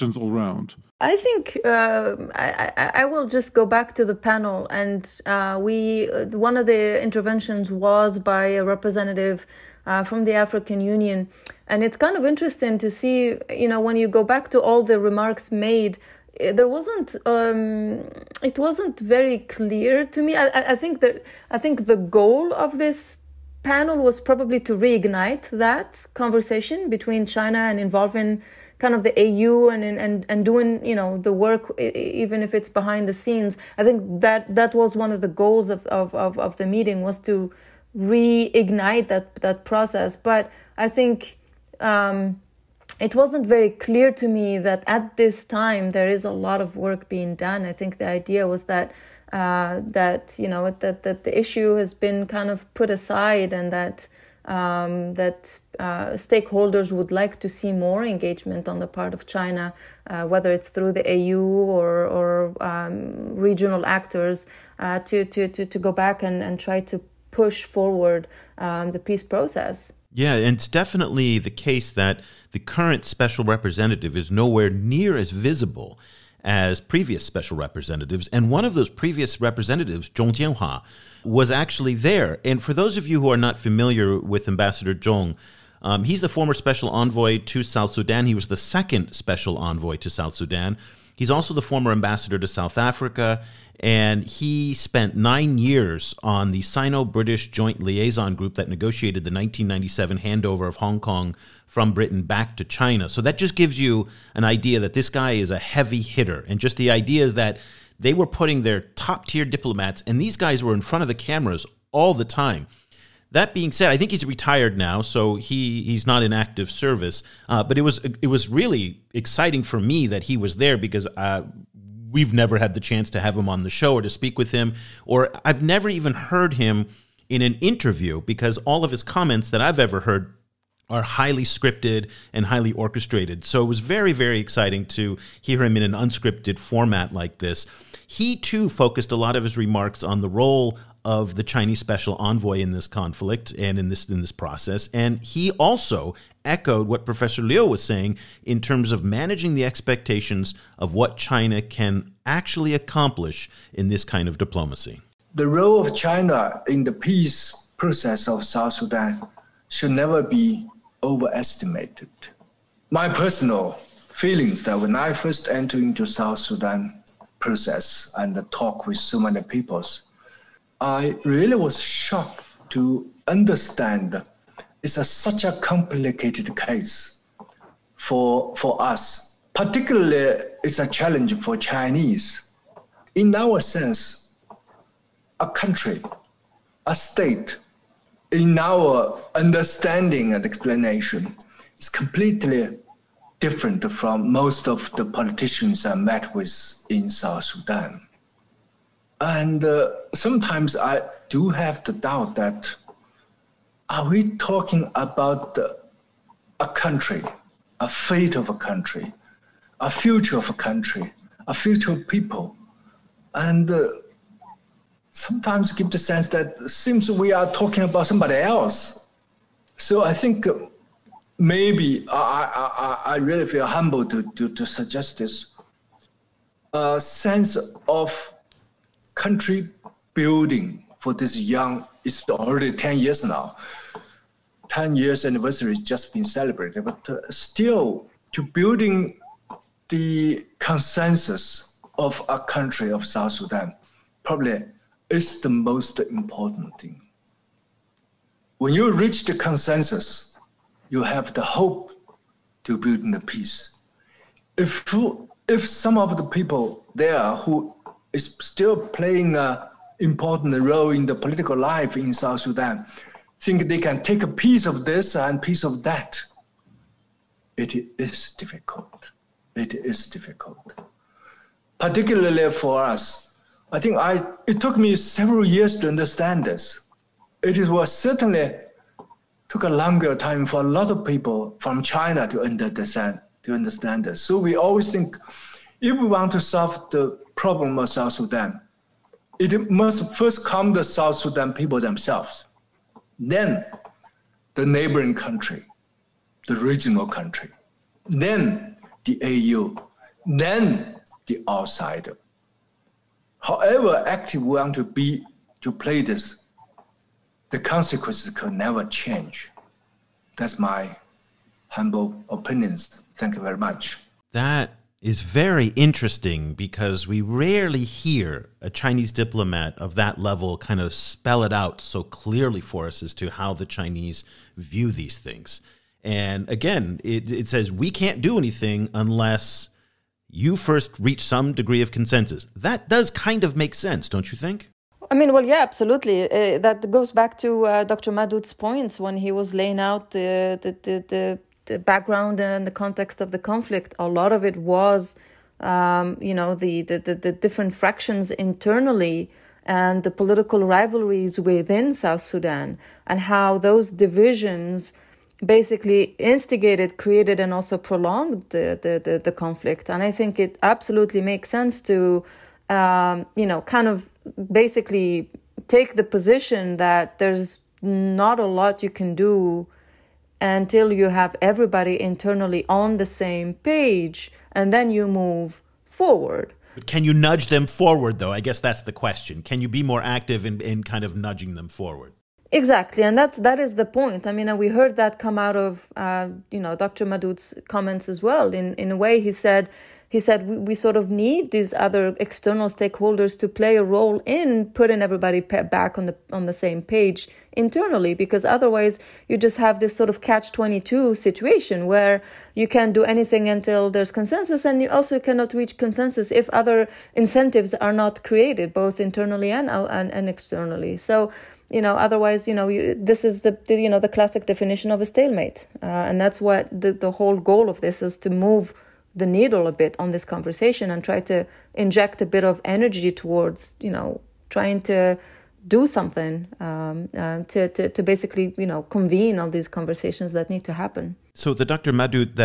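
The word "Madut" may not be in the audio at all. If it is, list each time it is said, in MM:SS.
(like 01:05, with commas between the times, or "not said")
05:38, 06:27, 07:11.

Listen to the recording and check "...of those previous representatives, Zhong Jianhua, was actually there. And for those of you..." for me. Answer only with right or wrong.
right.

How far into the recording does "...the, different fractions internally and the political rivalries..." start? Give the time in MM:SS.
05:47.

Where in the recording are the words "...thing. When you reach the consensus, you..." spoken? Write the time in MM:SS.
04:06.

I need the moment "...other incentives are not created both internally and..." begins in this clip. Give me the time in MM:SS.
06:46.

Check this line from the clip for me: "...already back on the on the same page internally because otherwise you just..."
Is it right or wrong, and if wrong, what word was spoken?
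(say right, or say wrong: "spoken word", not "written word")
wrong: "everybody", not "already".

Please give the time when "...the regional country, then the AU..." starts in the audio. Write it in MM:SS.
04:56.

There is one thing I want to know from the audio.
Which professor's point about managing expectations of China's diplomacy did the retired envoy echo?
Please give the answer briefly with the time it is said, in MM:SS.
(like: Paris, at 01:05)
Professor Liu, at 02:27.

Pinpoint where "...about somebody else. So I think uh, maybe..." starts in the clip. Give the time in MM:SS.
03:37.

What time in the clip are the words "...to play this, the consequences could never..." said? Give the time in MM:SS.
05:05.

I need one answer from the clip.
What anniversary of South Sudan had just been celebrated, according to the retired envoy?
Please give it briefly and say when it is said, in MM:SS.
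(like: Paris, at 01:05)
10 years, at 03:54.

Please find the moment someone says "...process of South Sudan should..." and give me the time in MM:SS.
02:37.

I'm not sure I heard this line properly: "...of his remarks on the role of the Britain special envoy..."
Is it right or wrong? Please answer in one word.
wrong.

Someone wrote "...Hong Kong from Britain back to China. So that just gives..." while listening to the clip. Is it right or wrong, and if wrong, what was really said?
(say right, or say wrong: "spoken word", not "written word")
right.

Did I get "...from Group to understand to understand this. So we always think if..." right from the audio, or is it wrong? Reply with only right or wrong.
wrong.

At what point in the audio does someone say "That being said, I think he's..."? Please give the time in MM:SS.
01:53.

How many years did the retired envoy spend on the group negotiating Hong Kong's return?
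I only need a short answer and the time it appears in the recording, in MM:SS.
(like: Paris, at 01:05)
9, at 01:35.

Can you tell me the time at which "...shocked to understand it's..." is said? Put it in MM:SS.
02:51.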